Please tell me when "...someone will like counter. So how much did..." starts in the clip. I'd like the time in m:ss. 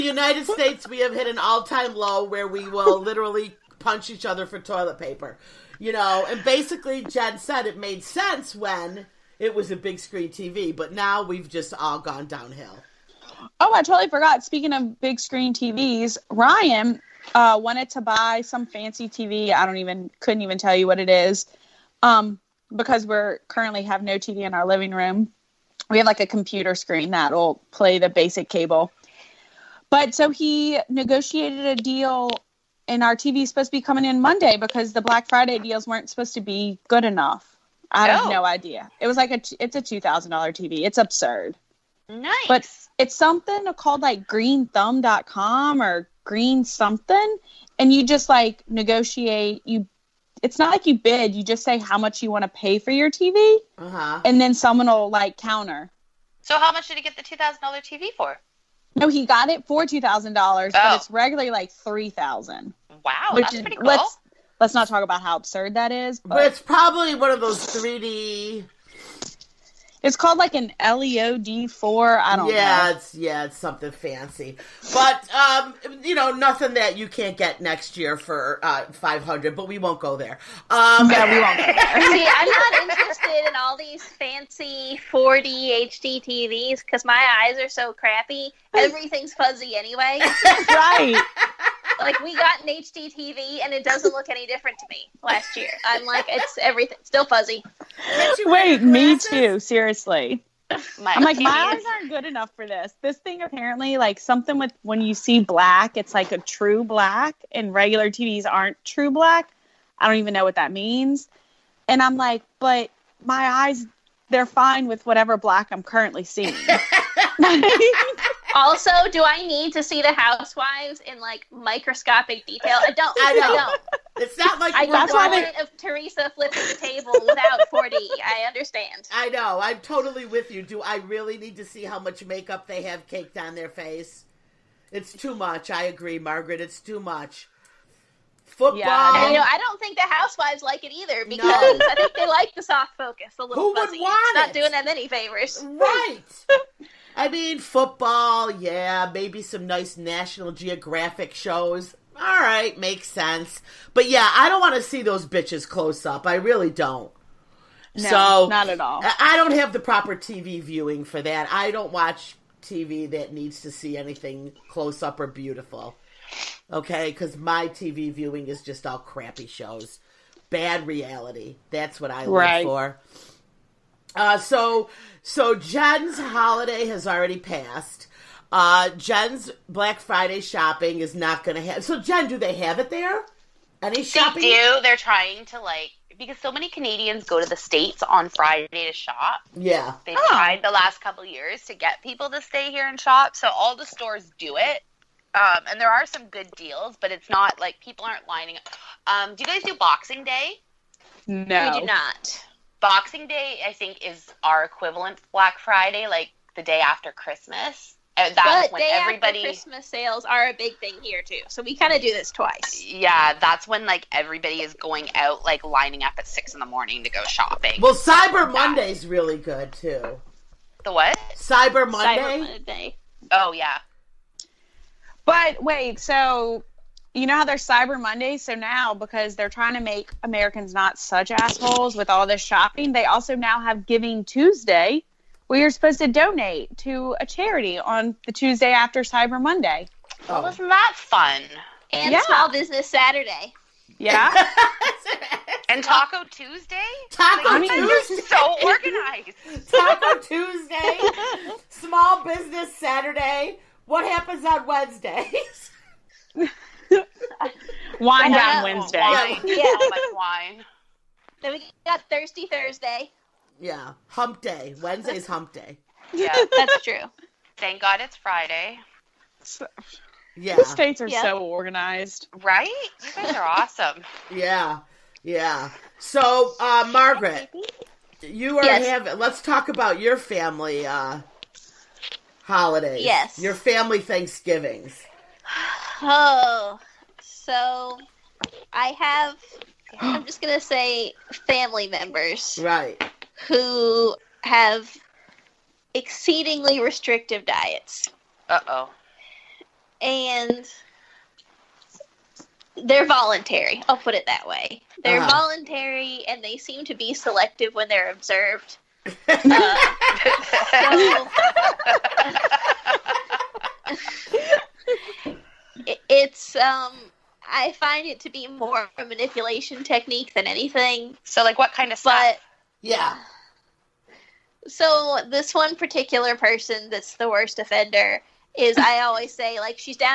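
0:54.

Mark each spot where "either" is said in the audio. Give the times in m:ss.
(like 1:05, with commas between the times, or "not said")
2:20.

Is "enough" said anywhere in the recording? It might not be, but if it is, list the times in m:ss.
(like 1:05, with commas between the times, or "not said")
0:37, 1:42.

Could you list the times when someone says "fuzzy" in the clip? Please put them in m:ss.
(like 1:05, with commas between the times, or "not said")
1:29, 1:37, 2:23.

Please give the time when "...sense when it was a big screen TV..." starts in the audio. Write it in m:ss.
0:08.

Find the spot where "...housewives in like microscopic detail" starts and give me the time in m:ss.
2:00.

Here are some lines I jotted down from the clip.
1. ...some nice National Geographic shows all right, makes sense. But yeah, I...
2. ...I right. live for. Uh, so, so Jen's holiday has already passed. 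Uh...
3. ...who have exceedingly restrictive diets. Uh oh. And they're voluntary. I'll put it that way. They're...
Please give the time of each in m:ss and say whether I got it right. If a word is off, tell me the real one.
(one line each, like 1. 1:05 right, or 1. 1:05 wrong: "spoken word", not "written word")
1. 2:29 right
2. 2:52 right
3. 4:53 right.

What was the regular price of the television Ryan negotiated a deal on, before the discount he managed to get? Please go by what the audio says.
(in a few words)
3000 dollars.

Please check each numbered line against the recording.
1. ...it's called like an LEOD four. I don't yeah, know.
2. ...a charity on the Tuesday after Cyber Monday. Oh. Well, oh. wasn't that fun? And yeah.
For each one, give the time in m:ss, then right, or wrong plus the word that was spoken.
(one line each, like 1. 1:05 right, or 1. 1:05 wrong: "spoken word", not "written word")
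1. 1:10 right
2. 3:57 right.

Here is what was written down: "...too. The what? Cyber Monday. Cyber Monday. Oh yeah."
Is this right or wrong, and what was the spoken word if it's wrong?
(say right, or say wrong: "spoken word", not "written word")
right.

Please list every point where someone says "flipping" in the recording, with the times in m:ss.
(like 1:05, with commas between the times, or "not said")
2:06.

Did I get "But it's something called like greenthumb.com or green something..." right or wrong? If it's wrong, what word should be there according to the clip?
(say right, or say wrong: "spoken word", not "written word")
right.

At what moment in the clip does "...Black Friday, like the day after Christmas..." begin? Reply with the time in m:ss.
3:25.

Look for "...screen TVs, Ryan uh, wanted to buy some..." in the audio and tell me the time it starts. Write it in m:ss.
0:15.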